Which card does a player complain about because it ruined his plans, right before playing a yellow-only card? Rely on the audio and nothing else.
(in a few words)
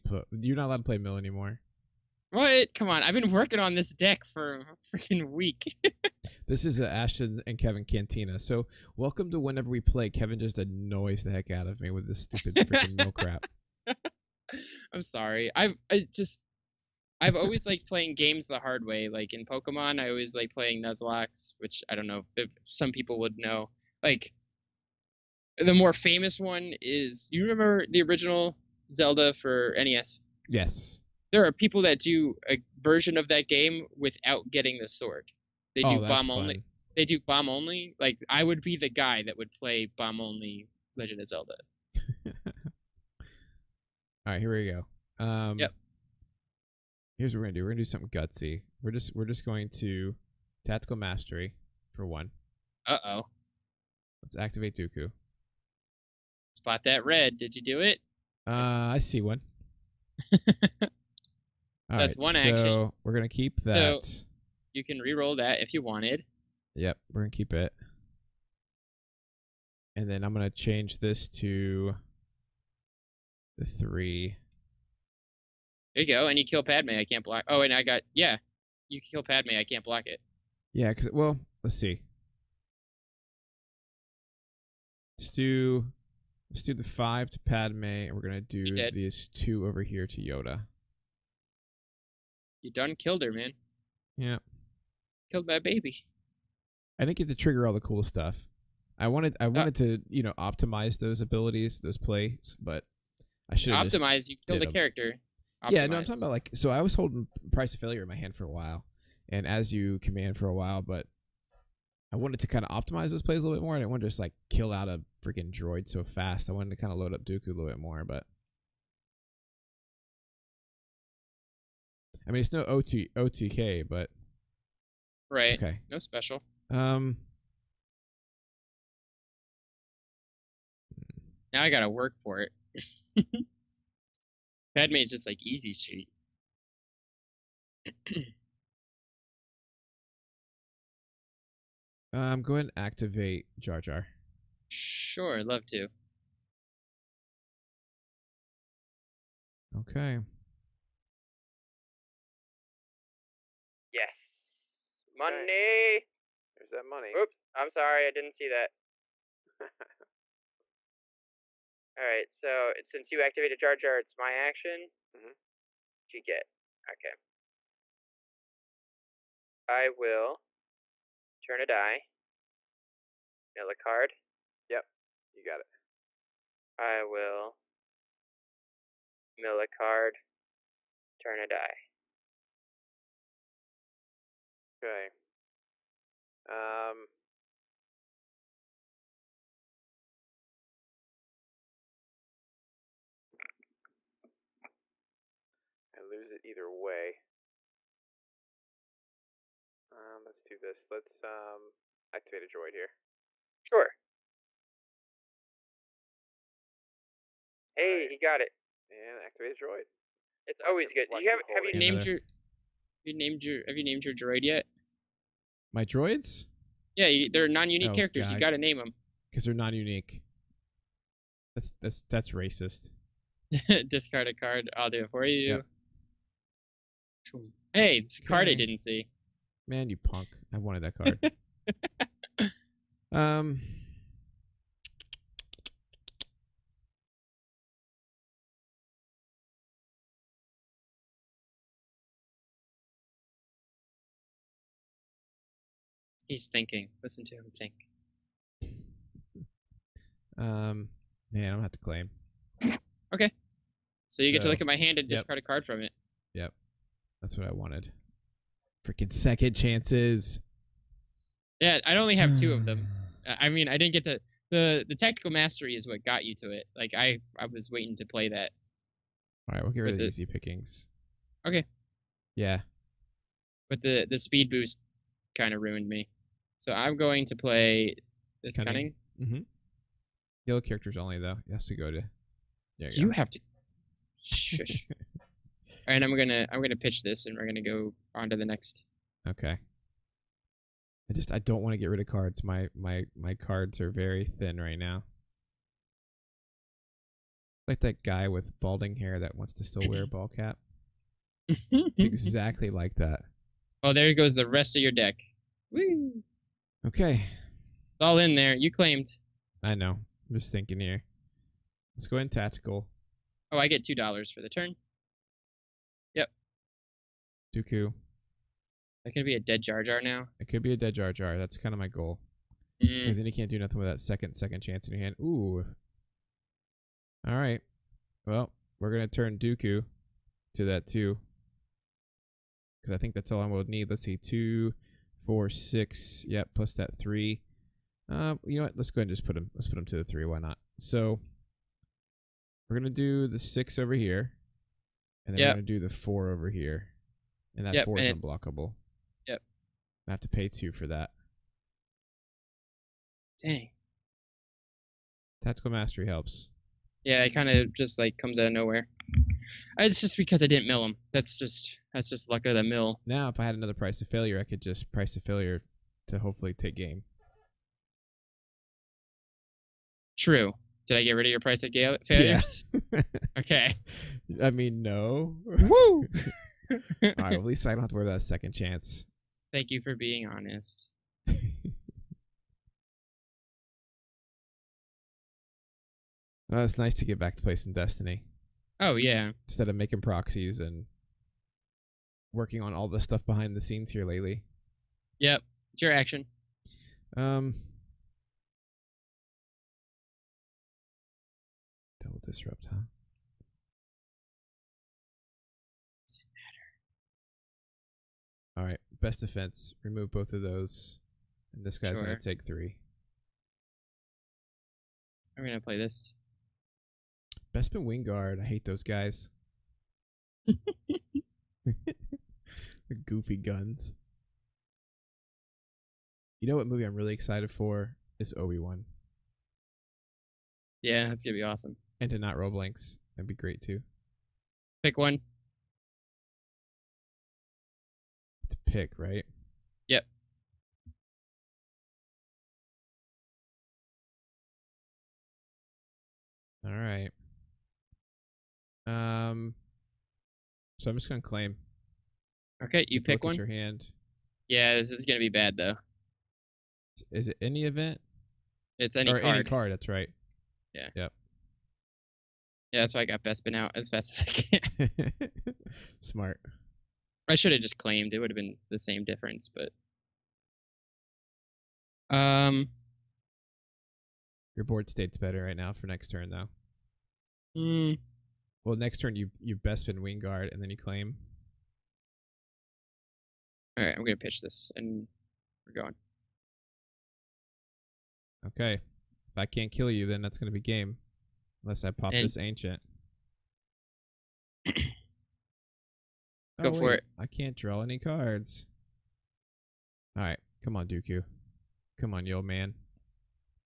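speed boost.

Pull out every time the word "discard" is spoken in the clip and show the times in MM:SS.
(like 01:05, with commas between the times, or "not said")
03:43, 04:15.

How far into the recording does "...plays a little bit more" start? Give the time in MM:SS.
01:53.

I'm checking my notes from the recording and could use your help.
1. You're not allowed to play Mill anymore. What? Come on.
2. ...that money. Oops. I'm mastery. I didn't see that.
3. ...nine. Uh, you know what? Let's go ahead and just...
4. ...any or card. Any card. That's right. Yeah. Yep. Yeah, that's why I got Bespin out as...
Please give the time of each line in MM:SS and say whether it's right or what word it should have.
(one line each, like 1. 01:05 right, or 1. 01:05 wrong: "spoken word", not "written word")
1. 00:00 right
2. 02:36 wrong: "sorry", not "mastery"
3. 05:36 wrong: "three", not "nine"
4. 07:38 right.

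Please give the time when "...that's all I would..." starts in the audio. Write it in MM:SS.
05:33.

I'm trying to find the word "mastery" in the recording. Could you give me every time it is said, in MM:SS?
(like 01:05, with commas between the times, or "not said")
00:50, 04:25, 05:55.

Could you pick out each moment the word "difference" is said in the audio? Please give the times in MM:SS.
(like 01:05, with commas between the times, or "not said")
07:49.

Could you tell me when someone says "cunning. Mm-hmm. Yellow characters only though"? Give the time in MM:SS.
04:38.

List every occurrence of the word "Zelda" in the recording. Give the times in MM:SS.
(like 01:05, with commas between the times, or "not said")
00:28, 00:41.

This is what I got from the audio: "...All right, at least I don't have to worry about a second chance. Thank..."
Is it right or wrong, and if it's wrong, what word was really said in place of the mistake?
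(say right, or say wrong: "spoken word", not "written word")
right.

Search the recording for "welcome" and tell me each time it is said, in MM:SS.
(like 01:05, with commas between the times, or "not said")
00:08.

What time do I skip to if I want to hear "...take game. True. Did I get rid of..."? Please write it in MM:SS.
06:06.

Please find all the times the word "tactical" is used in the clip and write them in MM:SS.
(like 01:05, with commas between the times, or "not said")
00:50, 04:24, 05:12, 05:55.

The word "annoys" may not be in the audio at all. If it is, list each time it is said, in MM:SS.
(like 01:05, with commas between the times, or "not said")
00:10.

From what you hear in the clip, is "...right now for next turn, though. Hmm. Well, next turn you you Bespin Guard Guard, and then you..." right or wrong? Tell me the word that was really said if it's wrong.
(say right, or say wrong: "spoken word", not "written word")
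wrong: "Wing", not "Guard".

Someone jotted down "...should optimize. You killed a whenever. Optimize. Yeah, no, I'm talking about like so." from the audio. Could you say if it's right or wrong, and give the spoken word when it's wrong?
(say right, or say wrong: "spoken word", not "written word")
wrong: "character", not "whenever".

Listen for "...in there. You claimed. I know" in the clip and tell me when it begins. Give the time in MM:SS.
05:08.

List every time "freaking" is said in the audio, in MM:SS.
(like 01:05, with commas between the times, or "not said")
00:04, 00:12, 01:55, 04:18.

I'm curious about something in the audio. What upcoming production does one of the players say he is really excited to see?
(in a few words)
Obi Wan.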